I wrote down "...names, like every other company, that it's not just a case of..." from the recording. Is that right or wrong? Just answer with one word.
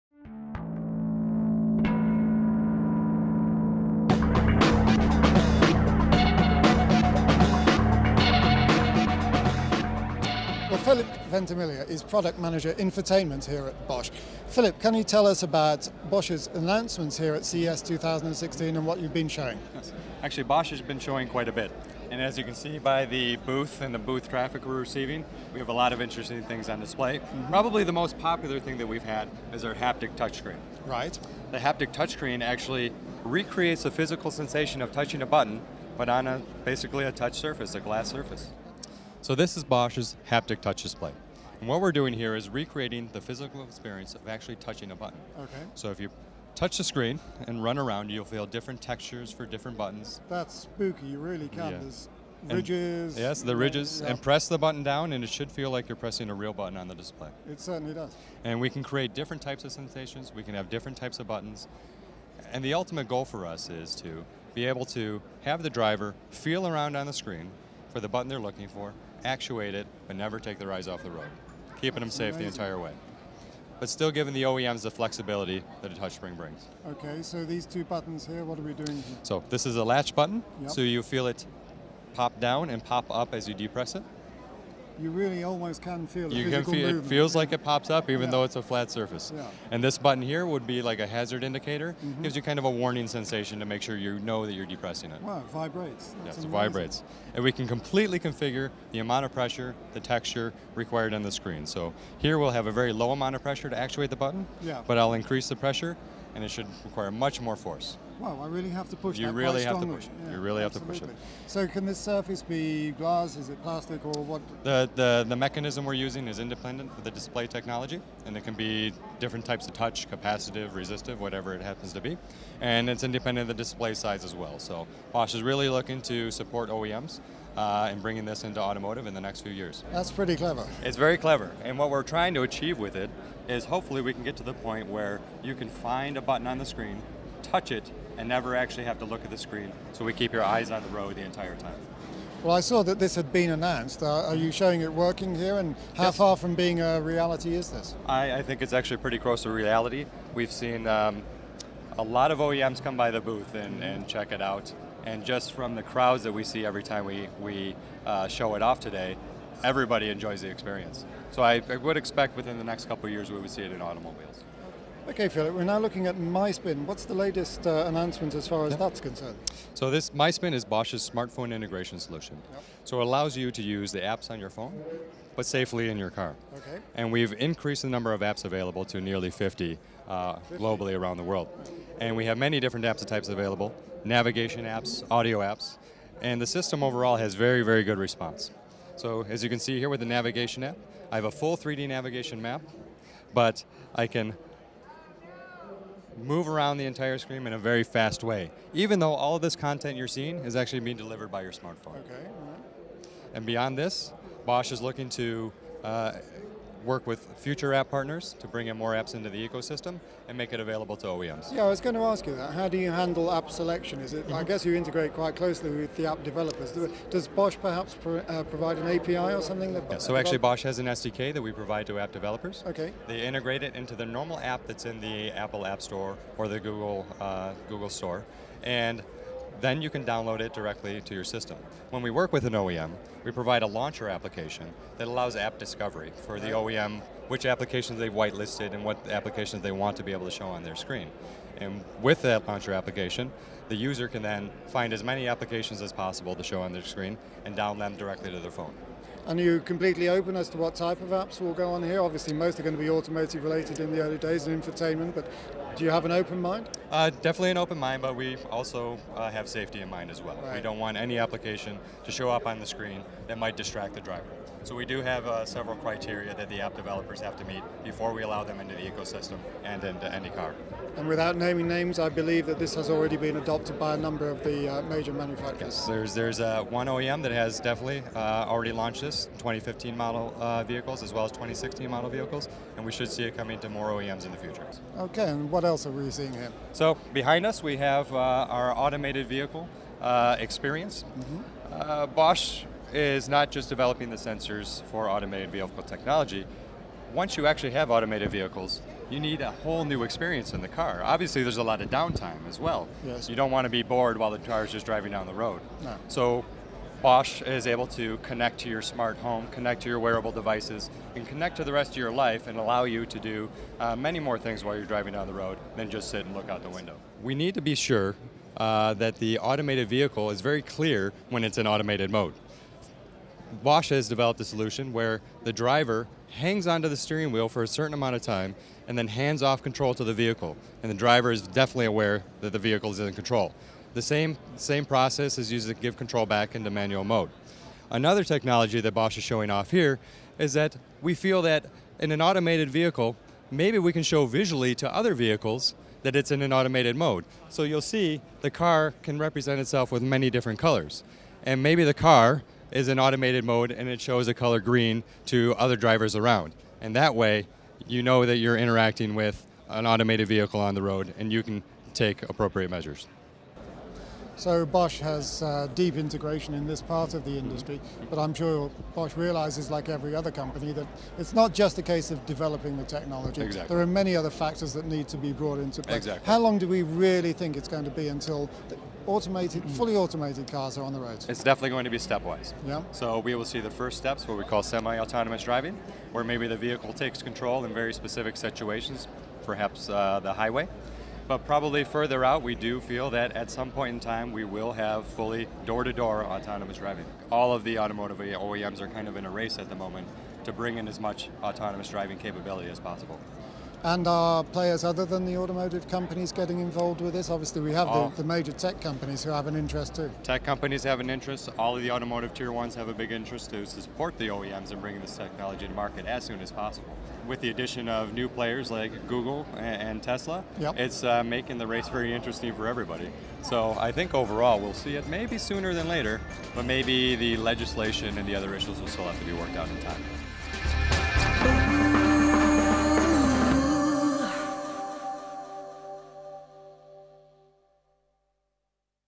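wrong.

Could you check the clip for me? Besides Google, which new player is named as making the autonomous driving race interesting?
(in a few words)
Tesla.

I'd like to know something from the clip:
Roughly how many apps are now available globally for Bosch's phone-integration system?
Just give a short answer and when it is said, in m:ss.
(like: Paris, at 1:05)
nearly 50, at 2:59.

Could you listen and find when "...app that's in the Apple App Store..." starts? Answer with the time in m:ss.
3:44.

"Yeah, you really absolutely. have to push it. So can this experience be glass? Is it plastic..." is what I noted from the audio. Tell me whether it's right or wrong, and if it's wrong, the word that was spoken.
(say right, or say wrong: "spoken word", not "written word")
wrong: "surface", not "experience".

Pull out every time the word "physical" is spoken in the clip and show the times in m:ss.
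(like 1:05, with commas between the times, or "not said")
0:33, 0:43.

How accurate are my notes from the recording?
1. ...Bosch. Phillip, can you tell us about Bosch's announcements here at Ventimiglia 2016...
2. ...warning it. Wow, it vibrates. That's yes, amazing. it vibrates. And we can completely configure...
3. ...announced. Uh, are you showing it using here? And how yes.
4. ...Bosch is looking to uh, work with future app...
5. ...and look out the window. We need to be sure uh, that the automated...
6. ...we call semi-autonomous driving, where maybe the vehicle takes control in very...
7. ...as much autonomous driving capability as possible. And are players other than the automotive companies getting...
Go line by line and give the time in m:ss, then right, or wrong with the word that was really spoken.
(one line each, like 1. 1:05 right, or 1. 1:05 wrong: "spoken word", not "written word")
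1. 0:13 wrong: "CES", not "Ventimiglia"
2. 1:34 wrong: "depressing", not "warning"
3. 2:23 wrong: "working", not "using"
4. 3:24 right
5. 5:16 right
6. 6:24 right
7. 6:40 right.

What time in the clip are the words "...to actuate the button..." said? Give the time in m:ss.
1:43.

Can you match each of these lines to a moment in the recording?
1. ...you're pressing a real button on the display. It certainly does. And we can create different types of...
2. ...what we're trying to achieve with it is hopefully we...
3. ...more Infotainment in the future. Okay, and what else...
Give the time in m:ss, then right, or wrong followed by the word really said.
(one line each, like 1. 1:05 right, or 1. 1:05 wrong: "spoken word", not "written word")
1. 0:55 right
2. 2:11 right
3. 4:43 wrong: "OEMs", not "Infotainment".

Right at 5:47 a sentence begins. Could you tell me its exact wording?
So you'll see the car can represent itself with many different colors.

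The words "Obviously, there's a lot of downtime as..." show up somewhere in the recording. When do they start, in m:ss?
5:01.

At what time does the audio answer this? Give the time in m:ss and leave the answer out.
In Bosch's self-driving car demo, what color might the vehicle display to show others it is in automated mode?
5:54.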